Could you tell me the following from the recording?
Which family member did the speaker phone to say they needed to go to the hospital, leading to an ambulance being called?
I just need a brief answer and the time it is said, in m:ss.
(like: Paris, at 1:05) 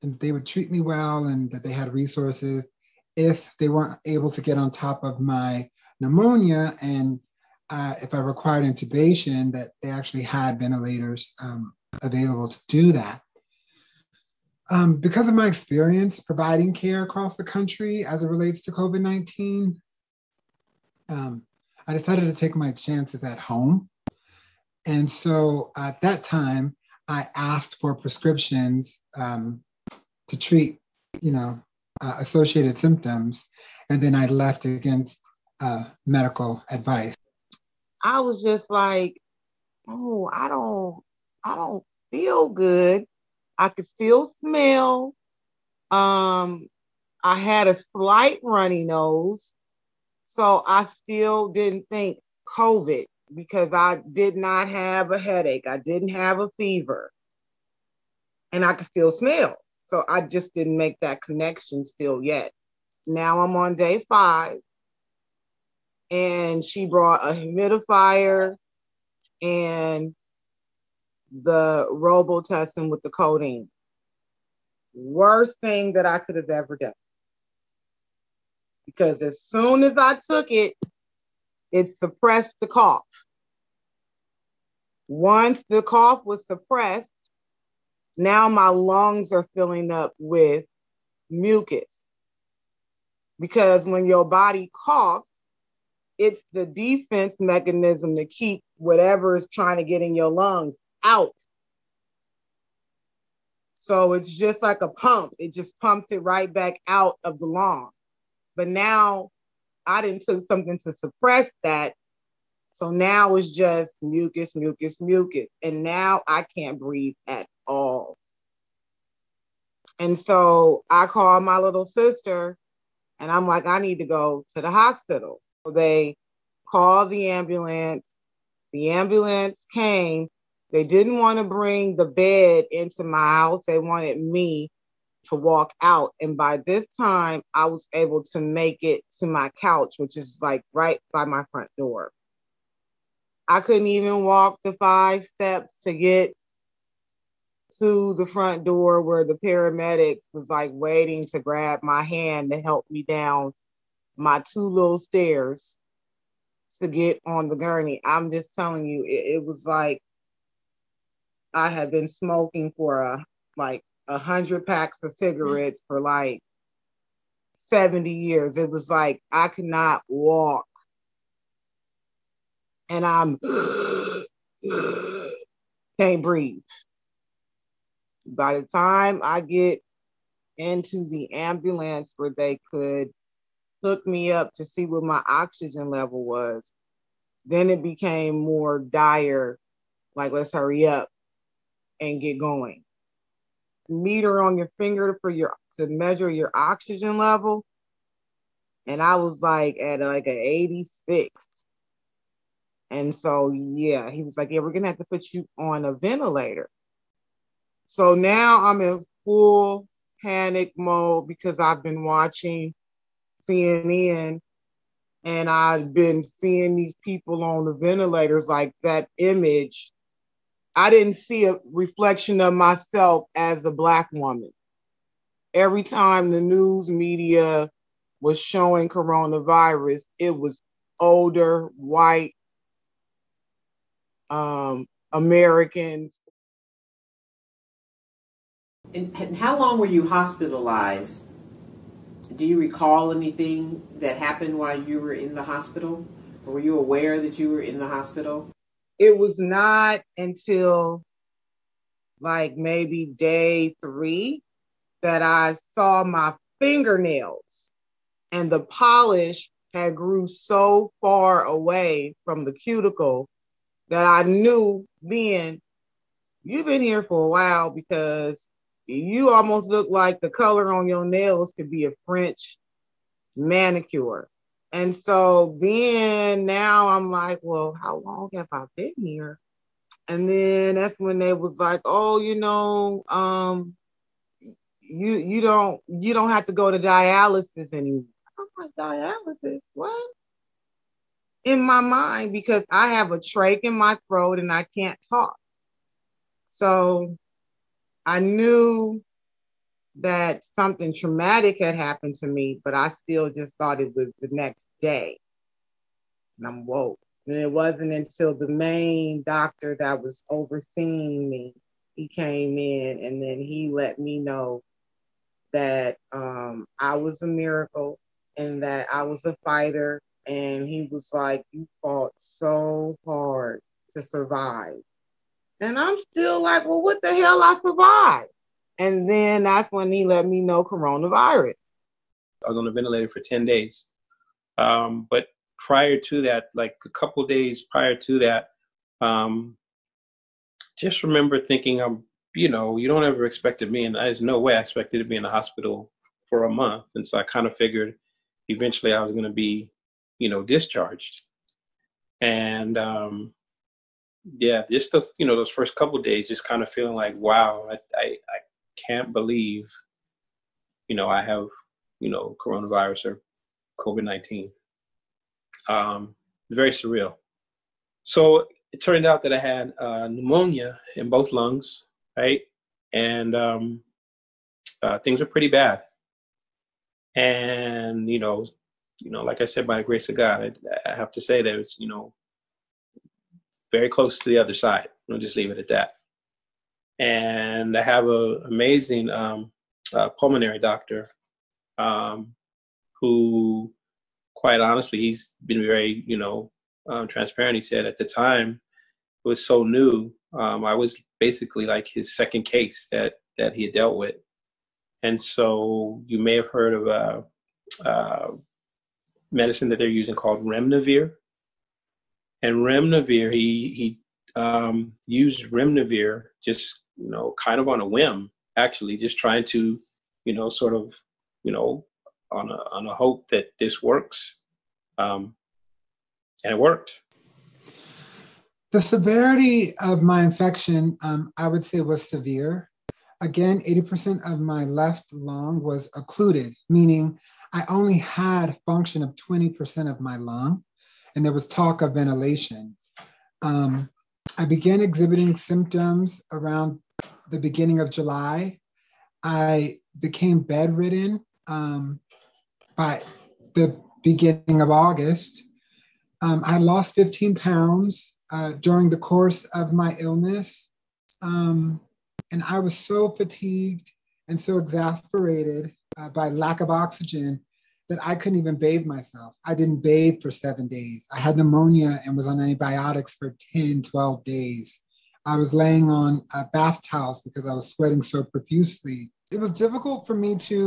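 Little sister, at 2:01.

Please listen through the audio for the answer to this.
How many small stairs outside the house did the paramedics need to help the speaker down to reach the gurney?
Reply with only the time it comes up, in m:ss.
2:34.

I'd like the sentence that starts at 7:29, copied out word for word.
I became bedridden um, by the beginning of August.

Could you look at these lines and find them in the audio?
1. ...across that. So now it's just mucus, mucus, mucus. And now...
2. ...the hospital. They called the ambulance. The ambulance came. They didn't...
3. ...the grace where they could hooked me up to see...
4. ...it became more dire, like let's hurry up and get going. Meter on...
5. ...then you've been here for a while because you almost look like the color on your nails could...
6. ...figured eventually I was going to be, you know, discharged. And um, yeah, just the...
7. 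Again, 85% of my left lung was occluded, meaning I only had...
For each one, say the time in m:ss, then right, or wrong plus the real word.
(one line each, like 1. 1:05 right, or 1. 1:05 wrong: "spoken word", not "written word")
1. 1:50 wrong: "suppress", not "across"
2. 2:04 right
3. 3:01 wrong: "ambulance", not "grace"
4. 3:07 right
5. 4:25 right
6. 5:47 right
7. 7:13 wrong: "80", not "85".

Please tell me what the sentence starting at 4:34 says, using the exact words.
And so then now I'm like, well, how long have I been here?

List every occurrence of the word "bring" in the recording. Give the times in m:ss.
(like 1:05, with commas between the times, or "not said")
2:11.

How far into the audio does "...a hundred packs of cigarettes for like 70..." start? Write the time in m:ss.
2:44.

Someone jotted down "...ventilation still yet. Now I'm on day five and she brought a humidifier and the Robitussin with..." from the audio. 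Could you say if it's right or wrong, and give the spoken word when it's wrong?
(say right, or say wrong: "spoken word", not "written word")
wrong: "connection", not "ventilation".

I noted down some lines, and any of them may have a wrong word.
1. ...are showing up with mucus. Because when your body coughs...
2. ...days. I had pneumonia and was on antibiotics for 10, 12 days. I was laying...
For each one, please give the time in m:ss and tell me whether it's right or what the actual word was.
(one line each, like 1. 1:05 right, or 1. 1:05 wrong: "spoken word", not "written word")
1. 1:29 wrong: "filling", not "showing"
2. 7:50 right.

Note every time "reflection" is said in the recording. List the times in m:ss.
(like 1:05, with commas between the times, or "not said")
3:41.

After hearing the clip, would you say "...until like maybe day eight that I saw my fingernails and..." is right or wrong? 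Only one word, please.
wrong.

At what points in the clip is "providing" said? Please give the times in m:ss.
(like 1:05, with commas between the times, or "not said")
0:16.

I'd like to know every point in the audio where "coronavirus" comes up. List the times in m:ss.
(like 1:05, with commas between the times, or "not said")
3:48, 5:30, 6:02.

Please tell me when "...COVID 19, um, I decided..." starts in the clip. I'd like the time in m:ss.
0:18.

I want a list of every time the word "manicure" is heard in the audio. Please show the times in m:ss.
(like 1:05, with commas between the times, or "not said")
4:33.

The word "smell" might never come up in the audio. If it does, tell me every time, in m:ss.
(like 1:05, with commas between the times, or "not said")
0:44, 0:59.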